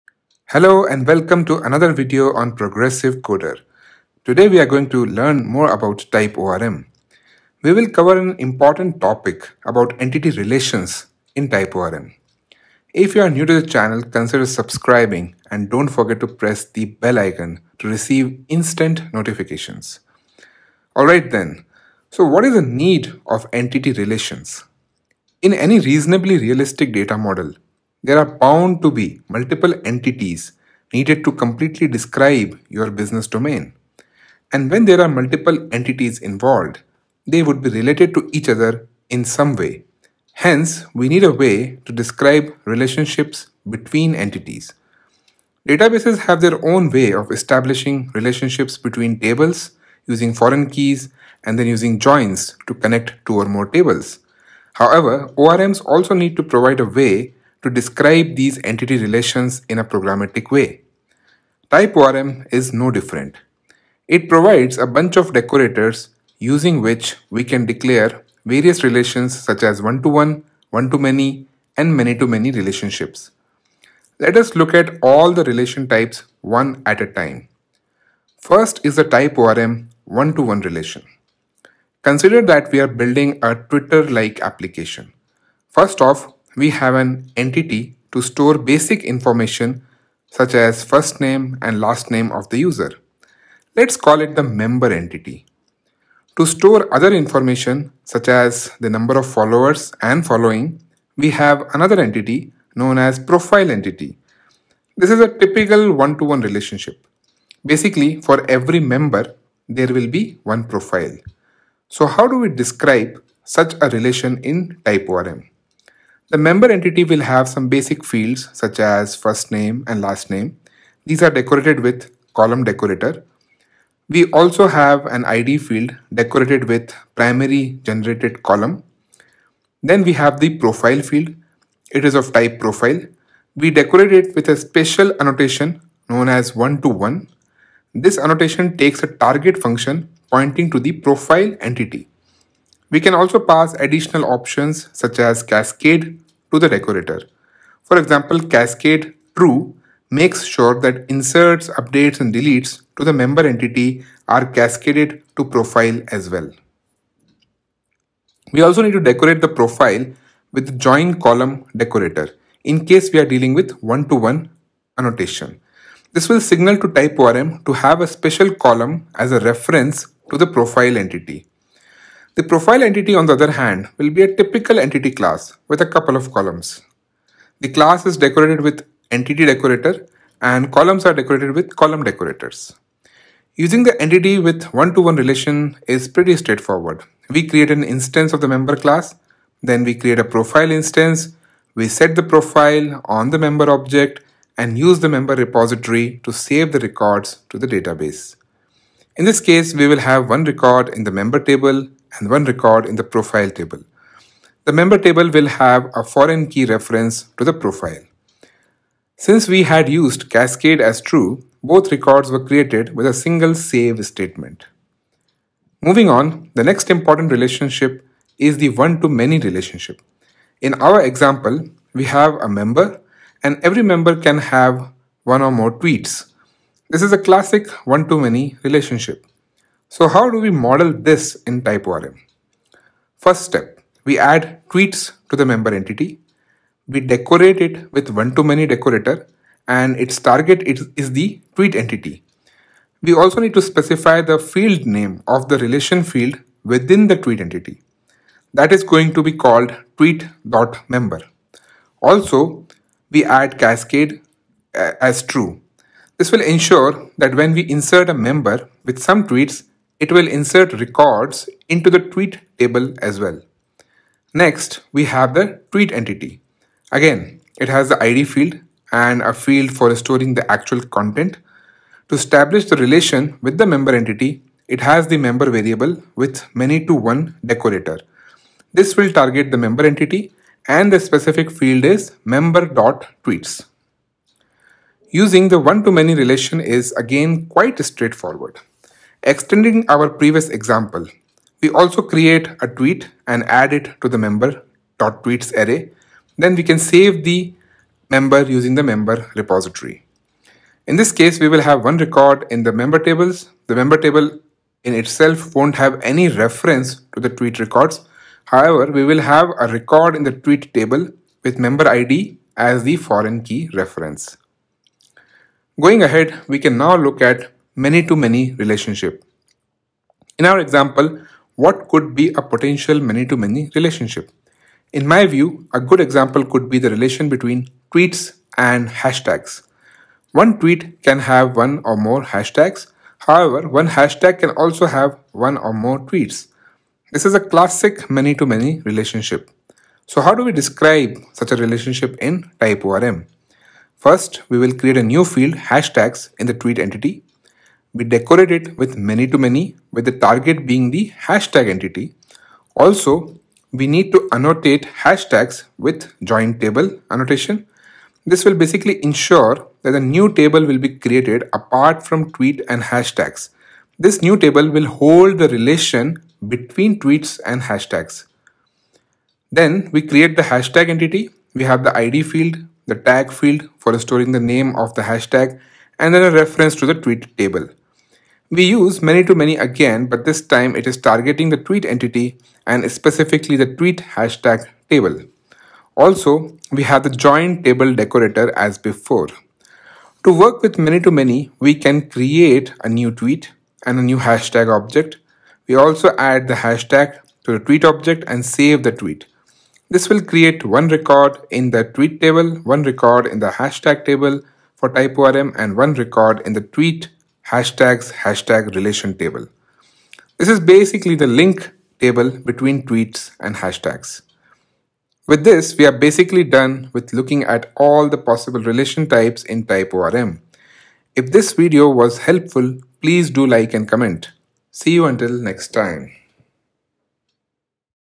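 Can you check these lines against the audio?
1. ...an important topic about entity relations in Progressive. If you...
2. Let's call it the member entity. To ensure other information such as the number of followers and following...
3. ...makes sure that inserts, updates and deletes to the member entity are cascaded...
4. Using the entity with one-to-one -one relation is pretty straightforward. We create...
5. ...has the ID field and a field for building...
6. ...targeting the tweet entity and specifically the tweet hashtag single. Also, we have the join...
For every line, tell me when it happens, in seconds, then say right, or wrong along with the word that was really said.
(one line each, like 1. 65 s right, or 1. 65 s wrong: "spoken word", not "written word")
1. 8 s wrong: "TypeORM", not "Progressive"
2. 93 s wrong: "store", not "ensure"
3. 150 s right
4. 183 s right
5. 267 s wrong: "storing", not "building"
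6. 380 s wrong: "table", not "single".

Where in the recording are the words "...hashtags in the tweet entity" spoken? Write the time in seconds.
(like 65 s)
345 s.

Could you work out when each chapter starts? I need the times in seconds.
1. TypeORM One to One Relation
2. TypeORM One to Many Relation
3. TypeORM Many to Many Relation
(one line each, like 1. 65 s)
1. 80 s
2. 218 s
3. 316 s.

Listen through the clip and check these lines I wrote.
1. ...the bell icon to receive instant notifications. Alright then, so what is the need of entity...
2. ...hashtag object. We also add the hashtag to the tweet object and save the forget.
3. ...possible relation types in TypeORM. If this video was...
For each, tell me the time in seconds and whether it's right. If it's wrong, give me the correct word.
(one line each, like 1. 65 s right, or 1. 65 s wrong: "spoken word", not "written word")
1. 16 s right
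2. 394 s wrong: "tweet", not "forget"
3. 418 s right.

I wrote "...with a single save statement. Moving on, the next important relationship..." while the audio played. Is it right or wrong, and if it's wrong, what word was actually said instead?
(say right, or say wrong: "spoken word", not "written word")
right.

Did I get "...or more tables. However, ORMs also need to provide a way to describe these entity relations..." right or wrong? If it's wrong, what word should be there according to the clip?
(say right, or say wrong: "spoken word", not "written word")
right.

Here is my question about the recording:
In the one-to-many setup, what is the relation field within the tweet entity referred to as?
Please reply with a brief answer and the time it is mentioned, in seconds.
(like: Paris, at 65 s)
tweet.member, at 249 s.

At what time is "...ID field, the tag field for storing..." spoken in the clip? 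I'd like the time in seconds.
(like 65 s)
371 s.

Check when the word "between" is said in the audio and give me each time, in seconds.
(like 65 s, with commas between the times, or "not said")
43 s, 48 s, 327 s, 366 s, 412 s.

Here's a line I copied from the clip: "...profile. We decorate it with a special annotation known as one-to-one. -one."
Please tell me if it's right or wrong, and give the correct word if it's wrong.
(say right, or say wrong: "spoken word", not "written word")
right.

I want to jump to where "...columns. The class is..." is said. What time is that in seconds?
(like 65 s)
176 s.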